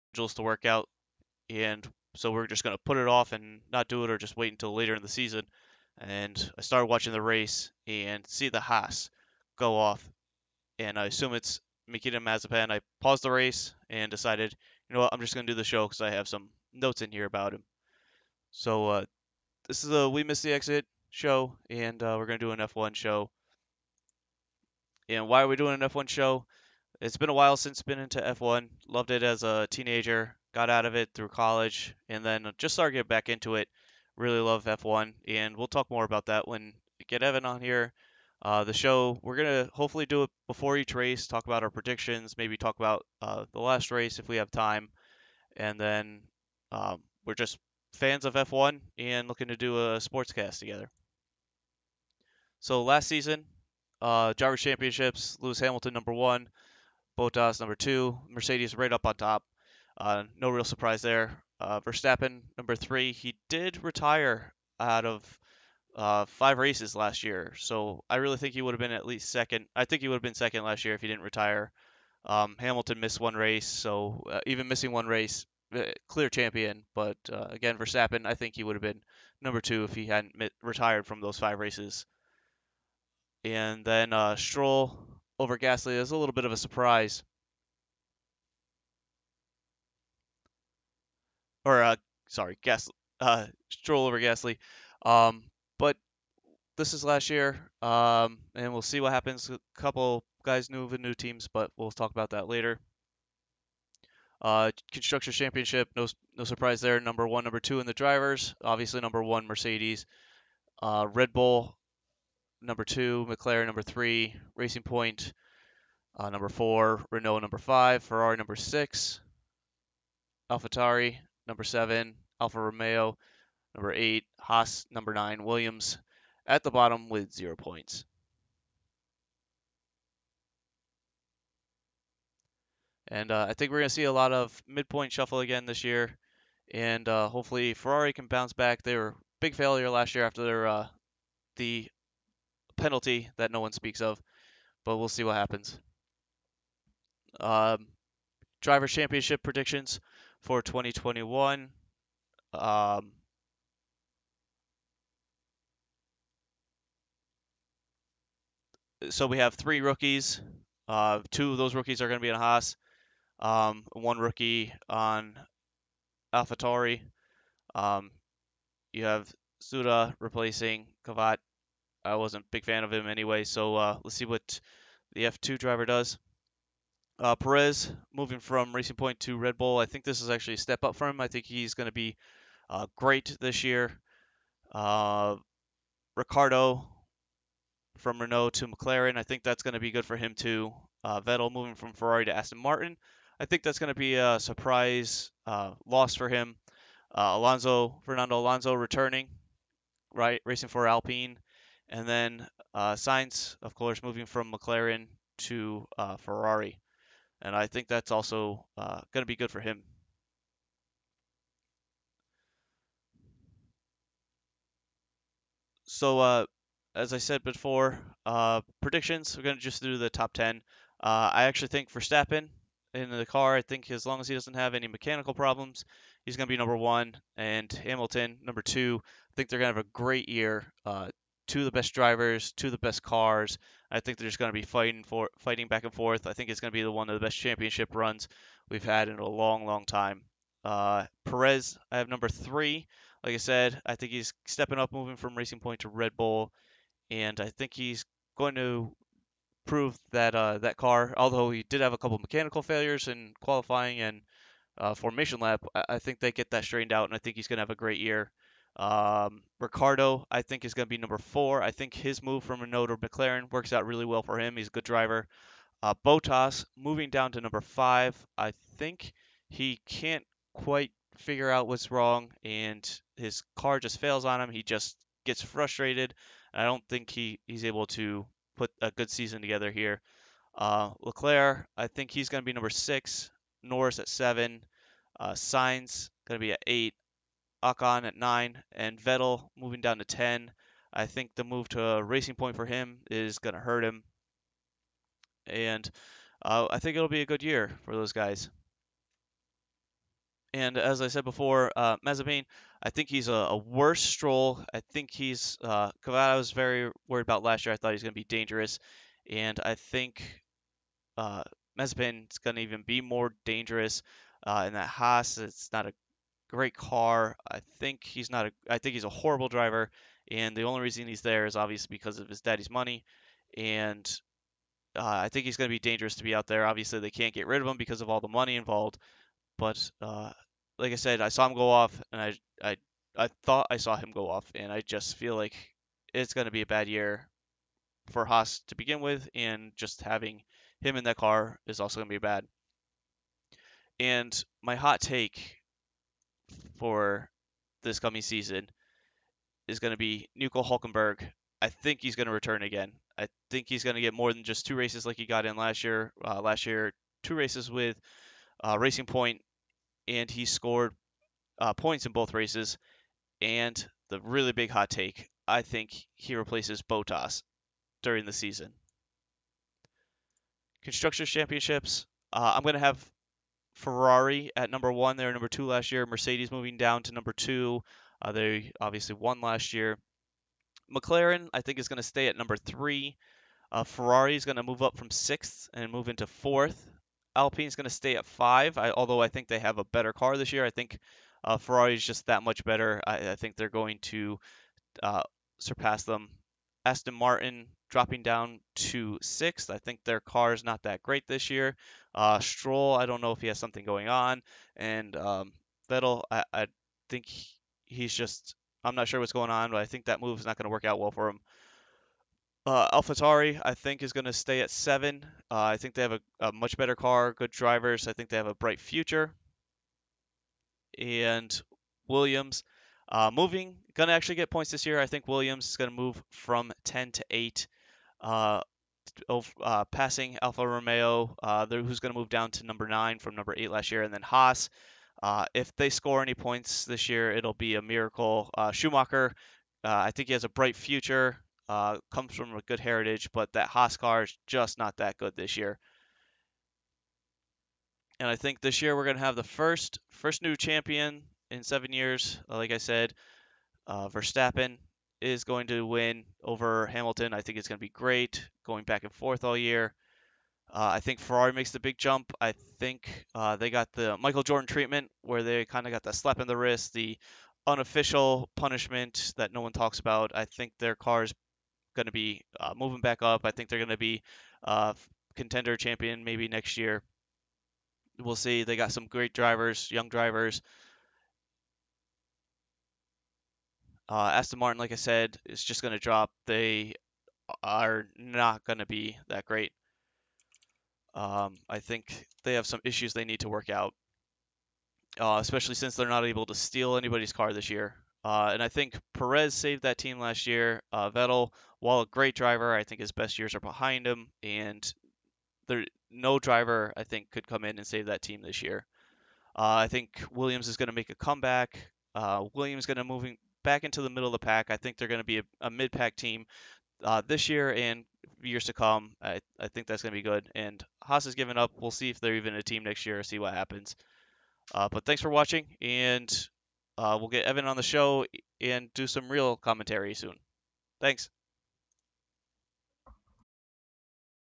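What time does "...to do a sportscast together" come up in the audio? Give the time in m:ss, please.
0:49.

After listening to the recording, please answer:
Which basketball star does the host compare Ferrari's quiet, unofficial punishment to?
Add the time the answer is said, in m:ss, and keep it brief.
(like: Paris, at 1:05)
Michael Jordan, at 7:44.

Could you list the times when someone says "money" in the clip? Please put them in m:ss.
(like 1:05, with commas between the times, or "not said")
5:22, 5:28.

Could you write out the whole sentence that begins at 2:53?
So uh, let's see what the F2 driver does.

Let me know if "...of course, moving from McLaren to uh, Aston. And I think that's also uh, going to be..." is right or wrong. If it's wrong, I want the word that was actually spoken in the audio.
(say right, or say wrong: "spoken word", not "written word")
wrong: "Ferrari", not "Aston".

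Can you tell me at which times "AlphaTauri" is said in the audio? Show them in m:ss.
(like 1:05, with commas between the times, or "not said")
2:00, 2:46, 6:52.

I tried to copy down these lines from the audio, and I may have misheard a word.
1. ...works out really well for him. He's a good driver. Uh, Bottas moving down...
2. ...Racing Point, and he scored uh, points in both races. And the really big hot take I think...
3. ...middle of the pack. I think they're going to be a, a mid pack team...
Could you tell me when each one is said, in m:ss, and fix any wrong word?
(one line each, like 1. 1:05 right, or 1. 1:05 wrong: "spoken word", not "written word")
1. 4:23 right
2. 5:58 right
3. 8:34 right.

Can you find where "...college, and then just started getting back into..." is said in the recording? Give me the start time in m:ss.
0:31.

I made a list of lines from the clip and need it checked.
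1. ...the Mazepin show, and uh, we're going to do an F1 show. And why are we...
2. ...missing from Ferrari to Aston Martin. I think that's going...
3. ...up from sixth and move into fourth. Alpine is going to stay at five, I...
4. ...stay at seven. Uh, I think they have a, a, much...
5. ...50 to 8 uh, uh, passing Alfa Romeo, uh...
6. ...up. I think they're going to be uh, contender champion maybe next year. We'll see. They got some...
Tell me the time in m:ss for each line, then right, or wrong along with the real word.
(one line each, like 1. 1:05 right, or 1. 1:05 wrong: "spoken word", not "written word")
1. 0:20 wrong: "Exit", not "Mazepin"
2. 3:11 wrong: "moving", not "missing"
3. 6:24 right
4. 6:54 right
5. 7:06 wrong: "10", not "50"
6. 7:53 right.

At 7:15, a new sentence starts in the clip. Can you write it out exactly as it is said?
Uh, if they score any points this year, it'll be a miracle.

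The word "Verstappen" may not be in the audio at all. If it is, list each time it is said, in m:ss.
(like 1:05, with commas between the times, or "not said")
1:01, 1:17, 3:41, 7:33.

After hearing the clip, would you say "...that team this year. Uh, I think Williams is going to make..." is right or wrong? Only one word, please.
right.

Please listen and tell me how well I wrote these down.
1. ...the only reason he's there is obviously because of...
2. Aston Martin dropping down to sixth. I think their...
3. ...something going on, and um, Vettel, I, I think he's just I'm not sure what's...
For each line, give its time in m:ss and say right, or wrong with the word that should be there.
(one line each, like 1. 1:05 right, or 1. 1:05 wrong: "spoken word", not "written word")
1. 5:20 right
2. 6:36 right
3. 6:43 right.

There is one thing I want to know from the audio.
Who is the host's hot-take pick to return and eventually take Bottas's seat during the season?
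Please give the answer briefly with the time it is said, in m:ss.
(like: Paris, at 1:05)
Nico Hulkenberg, at 5:50.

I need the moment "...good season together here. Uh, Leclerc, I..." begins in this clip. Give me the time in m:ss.
4:38.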